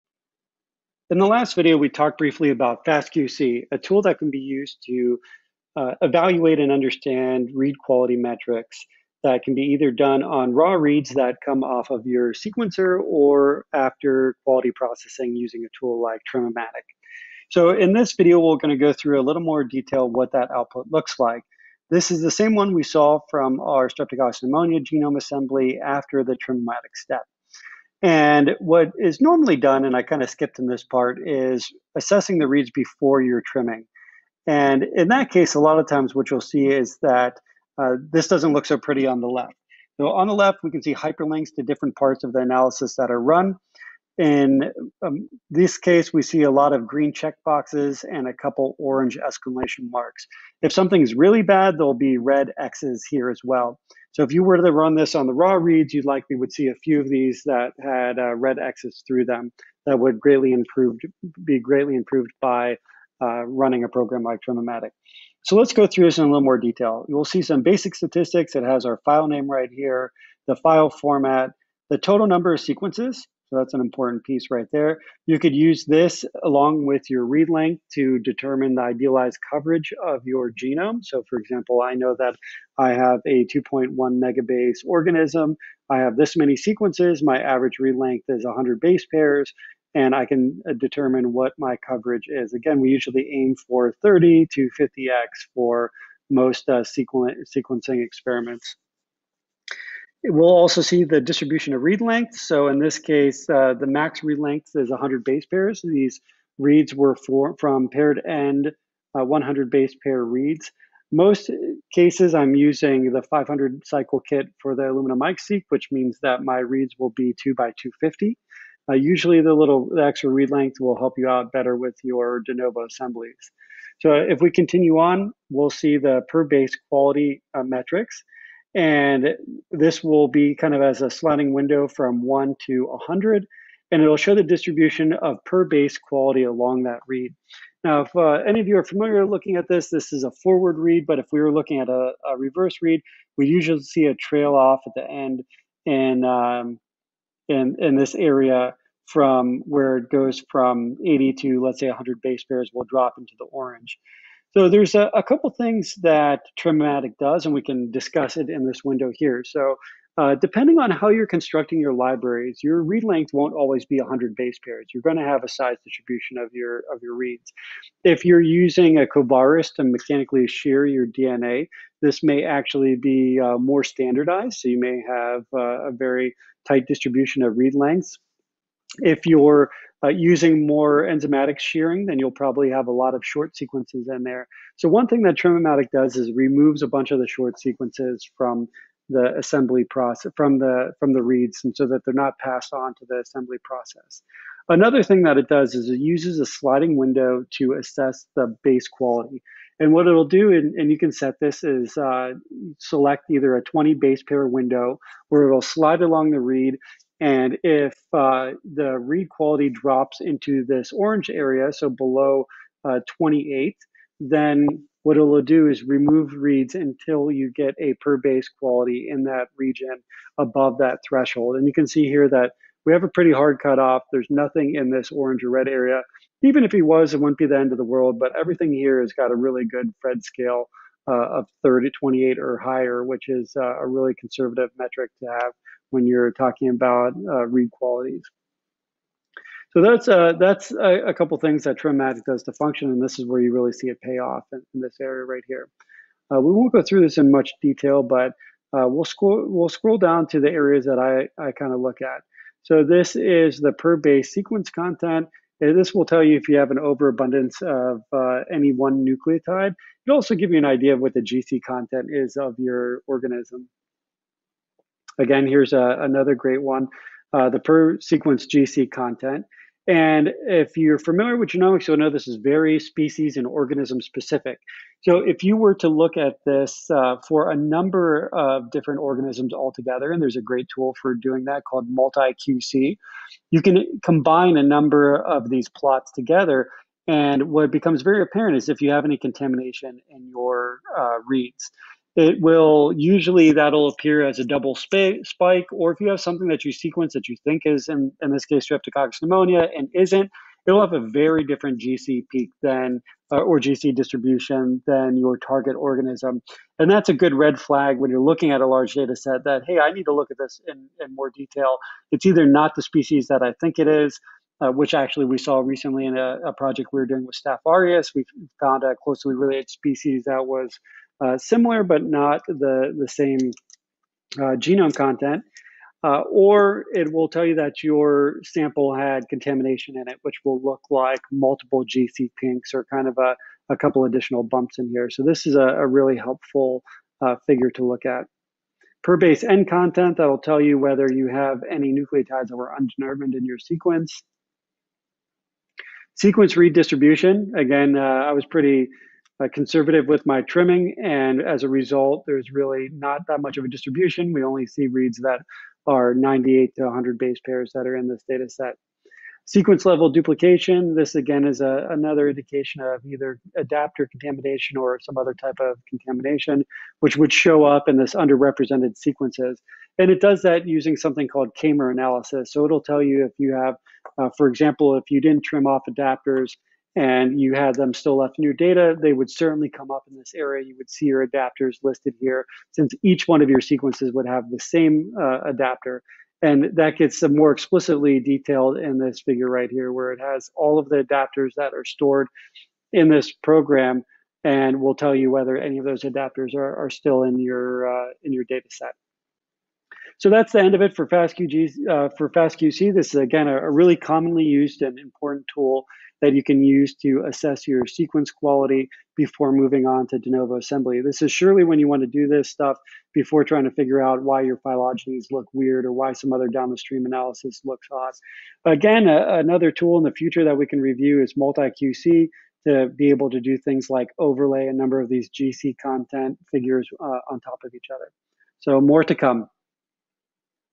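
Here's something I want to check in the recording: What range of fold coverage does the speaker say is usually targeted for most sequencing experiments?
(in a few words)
30 to 50x.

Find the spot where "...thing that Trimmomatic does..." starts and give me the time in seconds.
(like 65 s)
185 s.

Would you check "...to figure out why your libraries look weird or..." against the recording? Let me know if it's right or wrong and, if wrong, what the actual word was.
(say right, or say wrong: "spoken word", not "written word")
wrong: "phylogenies", not "libraries".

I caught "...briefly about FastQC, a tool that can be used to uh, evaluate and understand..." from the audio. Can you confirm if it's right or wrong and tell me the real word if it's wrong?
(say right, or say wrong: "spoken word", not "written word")
right.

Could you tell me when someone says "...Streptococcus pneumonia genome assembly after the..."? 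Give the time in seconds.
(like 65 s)
23 s.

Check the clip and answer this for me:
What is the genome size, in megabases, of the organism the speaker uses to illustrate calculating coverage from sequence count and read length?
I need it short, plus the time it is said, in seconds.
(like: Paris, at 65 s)
2.1 megabase, at 83 s.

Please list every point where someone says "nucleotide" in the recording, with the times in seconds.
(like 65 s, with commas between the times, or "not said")
259 s, 341 s.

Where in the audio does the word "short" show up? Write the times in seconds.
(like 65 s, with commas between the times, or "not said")
183 s, 187 s.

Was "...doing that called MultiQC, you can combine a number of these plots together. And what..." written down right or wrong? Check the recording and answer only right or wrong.
right.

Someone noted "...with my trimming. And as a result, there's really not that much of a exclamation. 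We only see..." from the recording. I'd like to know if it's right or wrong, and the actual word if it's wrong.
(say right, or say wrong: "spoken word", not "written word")
wrong: "distribution", not "exclamation".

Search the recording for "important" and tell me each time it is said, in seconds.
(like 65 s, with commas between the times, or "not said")
73 s, 404 s.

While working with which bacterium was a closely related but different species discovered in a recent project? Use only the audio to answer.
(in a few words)
Staph aureus.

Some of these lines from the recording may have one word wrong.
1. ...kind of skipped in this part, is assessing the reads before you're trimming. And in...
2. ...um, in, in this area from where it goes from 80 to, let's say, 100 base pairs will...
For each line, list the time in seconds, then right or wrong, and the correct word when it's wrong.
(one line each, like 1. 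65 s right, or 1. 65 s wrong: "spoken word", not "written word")
1. 30 s right
2. 146 s right.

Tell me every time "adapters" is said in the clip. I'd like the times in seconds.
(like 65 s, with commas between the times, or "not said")
363 s, 375 s, 381 s, 385 s, 391 s, 396 s.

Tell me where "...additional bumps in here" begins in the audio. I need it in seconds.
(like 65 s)
334 s.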